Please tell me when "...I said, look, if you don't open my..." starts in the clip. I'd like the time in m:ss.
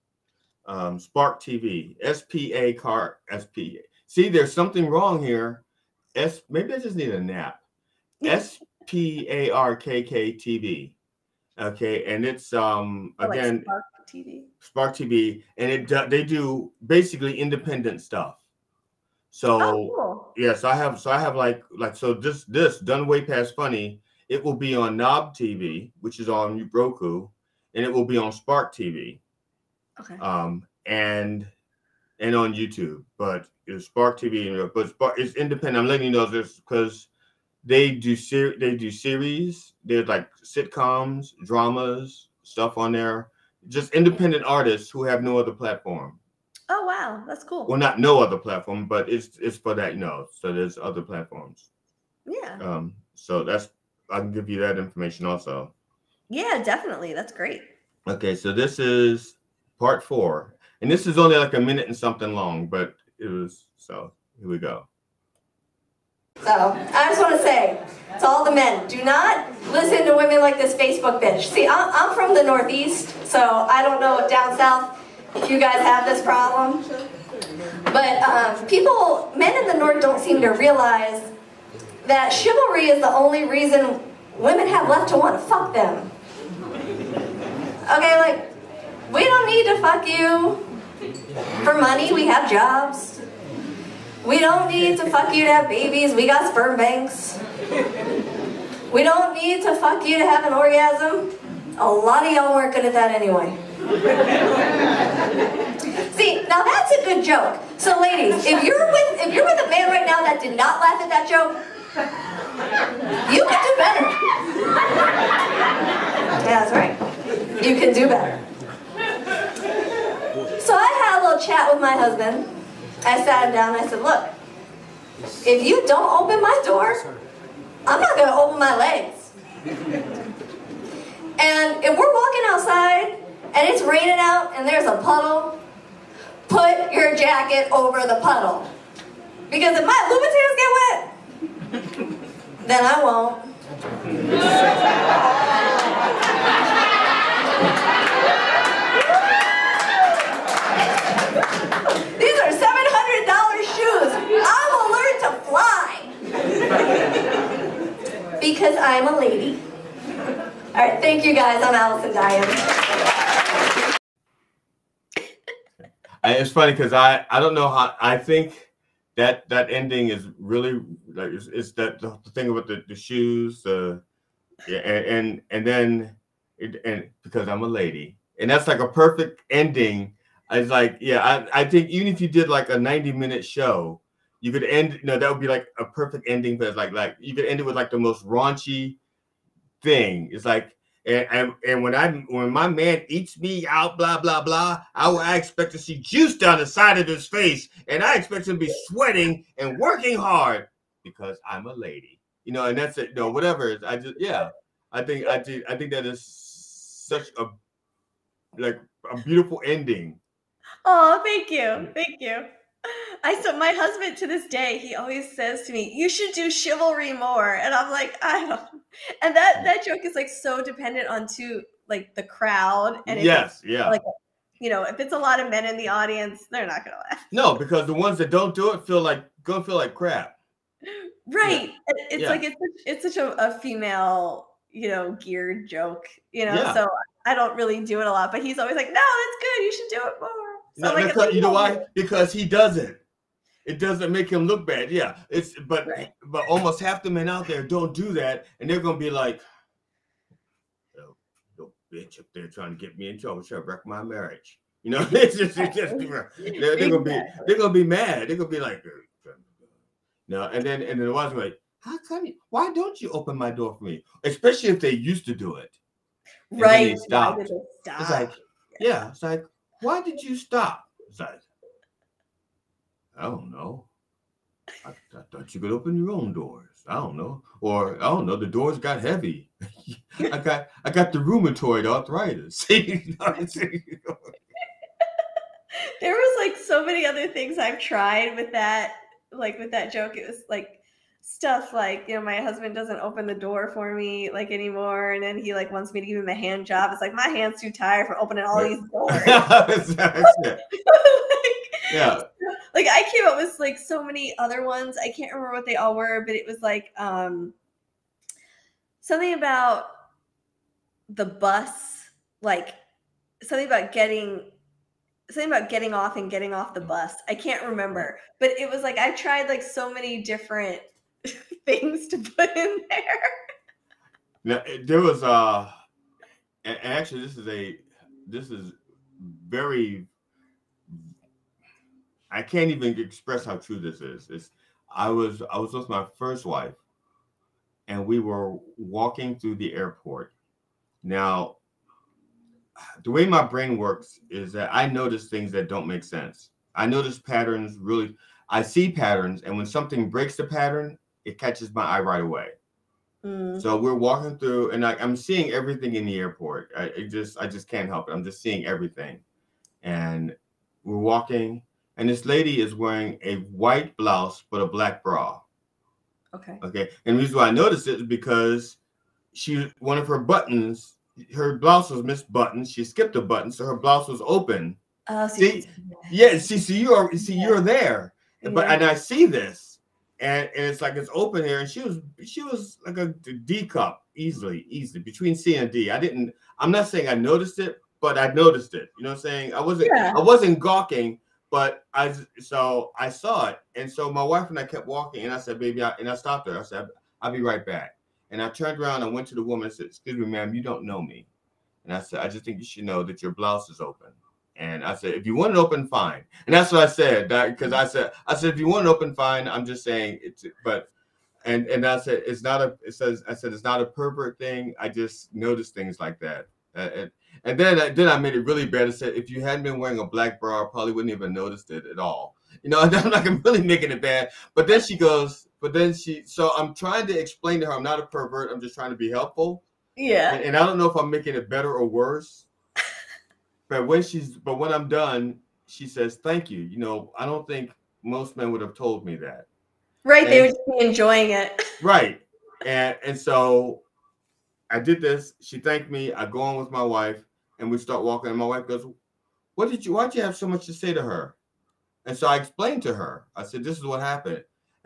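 2:03.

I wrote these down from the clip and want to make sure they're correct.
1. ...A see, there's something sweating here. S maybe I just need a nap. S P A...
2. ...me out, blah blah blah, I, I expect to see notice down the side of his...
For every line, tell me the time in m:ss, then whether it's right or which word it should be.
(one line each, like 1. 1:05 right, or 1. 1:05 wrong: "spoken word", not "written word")
1. 0:03 wrong: "wrong", not "sweating"
2. 3:13 wrong: "juice", not "notice".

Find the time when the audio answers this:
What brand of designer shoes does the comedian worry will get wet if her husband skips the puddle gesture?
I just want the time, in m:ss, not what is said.
2:21.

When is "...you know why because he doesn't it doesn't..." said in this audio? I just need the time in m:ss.
4:01.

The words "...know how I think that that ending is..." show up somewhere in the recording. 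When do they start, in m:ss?
2:47.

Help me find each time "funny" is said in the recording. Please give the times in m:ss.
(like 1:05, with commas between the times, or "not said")
0:23, 2:46.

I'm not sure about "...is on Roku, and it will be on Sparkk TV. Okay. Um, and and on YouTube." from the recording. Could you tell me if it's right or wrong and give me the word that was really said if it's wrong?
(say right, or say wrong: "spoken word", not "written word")
right.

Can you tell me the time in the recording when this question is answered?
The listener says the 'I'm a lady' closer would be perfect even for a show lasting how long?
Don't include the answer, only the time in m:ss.
3:02.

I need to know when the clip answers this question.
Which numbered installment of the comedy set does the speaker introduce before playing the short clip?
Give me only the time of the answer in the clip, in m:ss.
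0:59.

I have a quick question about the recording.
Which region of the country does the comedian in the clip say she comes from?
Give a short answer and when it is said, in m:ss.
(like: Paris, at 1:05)
The Northeast, at 1:12.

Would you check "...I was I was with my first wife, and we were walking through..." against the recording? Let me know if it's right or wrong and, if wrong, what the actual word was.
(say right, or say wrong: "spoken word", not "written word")
right.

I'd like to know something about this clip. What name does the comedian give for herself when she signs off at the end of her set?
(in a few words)
Allison Dyen.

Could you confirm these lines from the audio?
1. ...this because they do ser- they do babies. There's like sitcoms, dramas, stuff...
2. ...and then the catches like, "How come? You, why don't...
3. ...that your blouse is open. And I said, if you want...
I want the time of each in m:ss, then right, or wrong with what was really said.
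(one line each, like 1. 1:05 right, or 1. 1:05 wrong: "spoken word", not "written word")
1. 0:36 wrong: "series", not "babies"
2. 4:20 wrong: "wives", not "catches"
3. 6:43 right.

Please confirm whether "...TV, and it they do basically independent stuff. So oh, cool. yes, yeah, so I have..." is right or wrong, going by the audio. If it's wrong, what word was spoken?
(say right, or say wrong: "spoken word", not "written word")
right.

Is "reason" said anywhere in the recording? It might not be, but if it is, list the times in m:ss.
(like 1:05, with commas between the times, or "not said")
1:23, 6:07.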